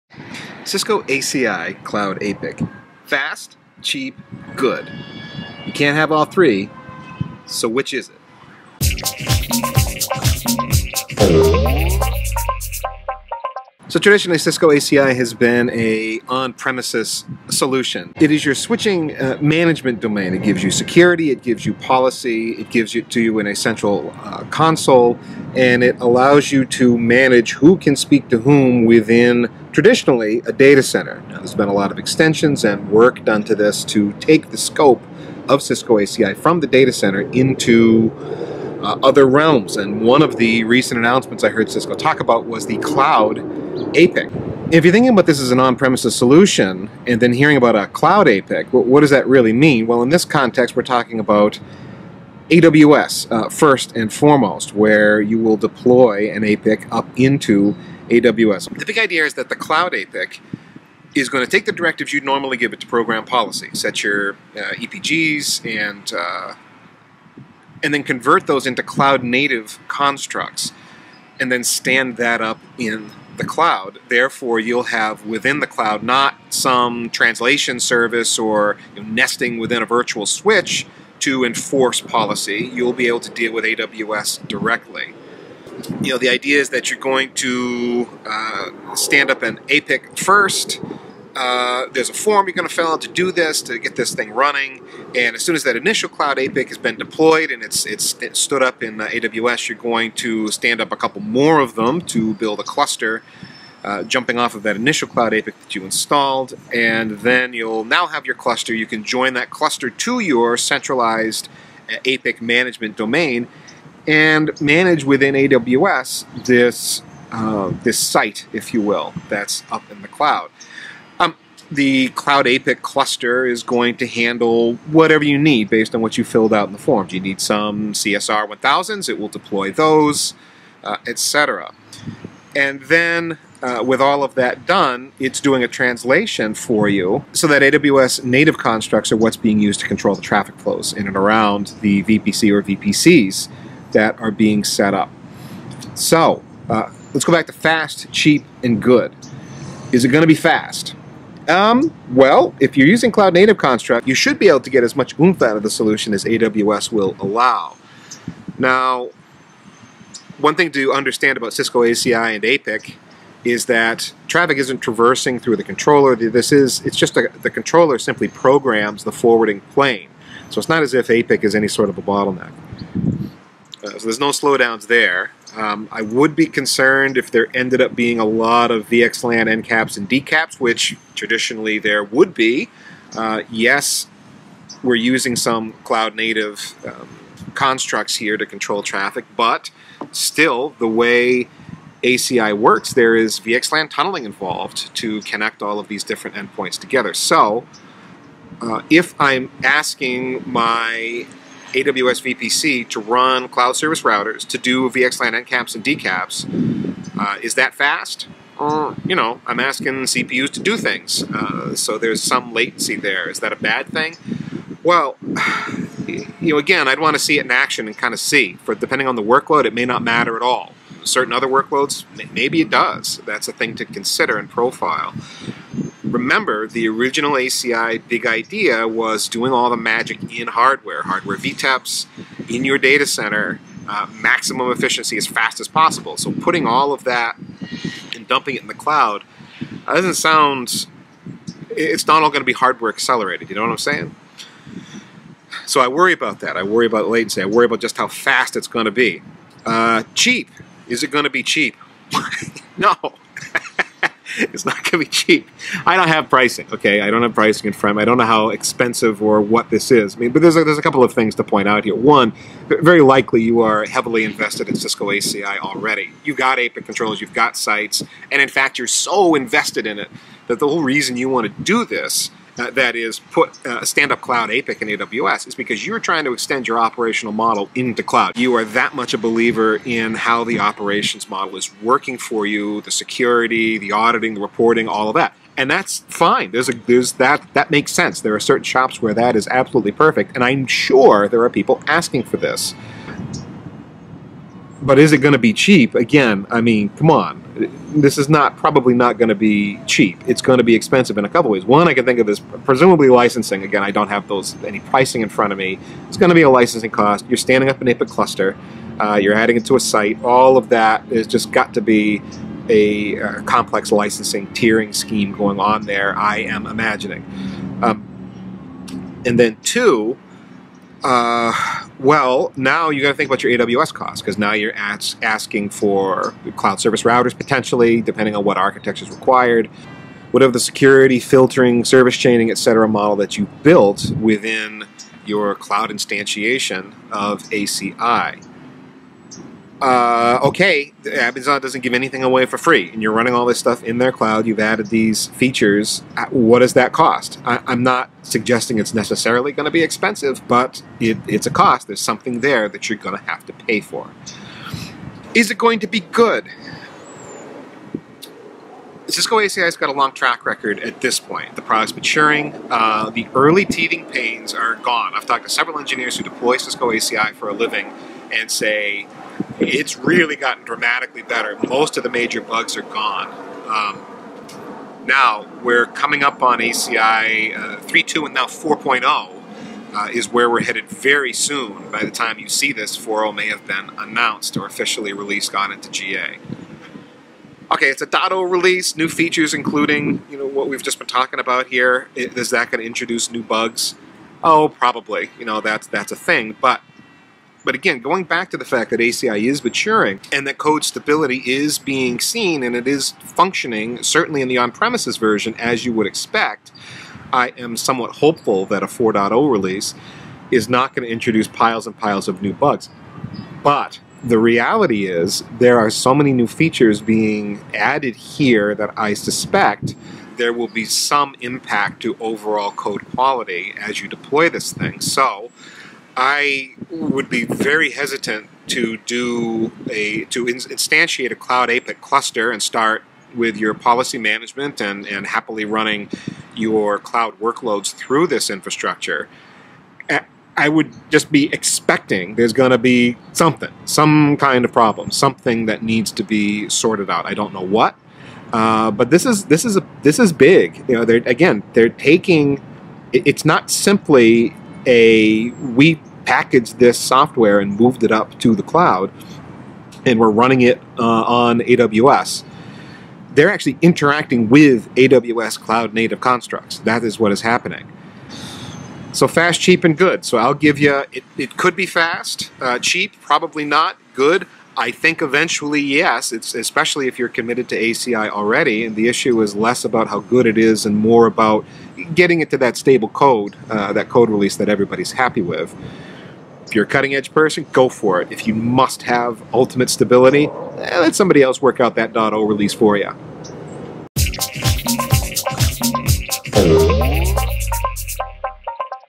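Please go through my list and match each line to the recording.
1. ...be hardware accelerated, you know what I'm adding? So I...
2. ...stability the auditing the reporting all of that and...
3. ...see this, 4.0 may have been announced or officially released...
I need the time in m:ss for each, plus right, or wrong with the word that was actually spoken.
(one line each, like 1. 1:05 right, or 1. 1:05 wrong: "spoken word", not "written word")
1. 4:02 wrong: "saying", not "adding"
2. 4:42 wrong: "security", not "stability"
3. 6:22 right.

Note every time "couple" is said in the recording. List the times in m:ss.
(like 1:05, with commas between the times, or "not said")
1:40, 4:20, 5:01.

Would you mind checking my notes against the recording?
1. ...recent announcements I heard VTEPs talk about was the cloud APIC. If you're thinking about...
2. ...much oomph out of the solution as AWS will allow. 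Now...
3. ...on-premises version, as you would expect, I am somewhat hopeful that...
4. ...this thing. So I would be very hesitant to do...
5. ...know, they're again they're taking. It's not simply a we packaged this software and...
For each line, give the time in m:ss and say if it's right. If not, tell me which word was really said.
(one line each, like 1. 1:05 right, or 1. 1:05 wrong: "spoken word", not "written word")
1. 0:40 wrong: "Cisco", not "VTEPs"
2. 2:34 right
3. 6:44 right
4. 7:04 right
5. 7:30 right.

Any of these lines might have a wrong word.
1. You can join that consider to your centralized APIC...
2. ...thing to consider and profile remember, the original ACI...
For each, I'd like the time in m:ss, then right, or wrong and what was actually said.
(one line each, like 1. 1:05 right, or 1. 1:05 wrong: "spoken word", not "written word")
1. 1:48 wrong: "cluster", not "consider"
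2. 3:43 right.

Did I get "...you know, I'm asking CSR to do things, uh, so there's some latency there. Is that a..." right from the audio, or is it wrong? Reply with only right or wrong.
wrong.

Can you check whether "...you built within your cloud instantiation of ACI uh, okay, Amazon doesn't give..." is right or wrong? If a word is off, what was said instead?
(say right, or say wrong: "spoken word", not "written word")
right.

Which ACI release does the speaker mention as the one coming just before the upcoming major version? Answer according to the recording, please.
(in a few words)
3.2.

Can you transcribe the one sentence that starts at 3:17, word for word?
So, uh, if I'm asking my AWS VPC to run cloud service routers to do VXLAN encaps and decaps.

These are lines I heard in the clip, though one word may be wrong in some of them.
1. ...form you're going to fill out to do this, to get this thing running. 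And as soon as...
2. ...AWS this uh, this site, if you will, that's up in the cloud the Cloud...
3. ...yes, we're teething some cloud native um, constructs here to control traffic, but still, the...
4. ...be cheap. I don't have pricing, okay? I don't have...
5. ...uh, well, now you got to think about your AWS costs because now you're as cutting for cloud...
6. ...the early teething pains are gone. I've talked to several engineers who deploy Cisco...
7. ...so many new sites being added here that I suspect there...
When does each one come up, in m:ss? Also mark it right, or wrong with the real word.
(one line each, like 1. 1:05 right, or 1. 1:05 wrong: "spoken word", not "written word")
1. 1:32 right
2. 1:55 right
3. 3:03 wrong: "using", not "teething"
4. 4:14 right
5. 5:21 wrong: "asking", not "cutting"
6. 6:03 right
7. 6:55 wrong: "features", not "sites".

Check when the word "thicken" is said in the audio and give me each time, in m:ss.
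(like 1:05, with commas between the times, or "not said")
not said.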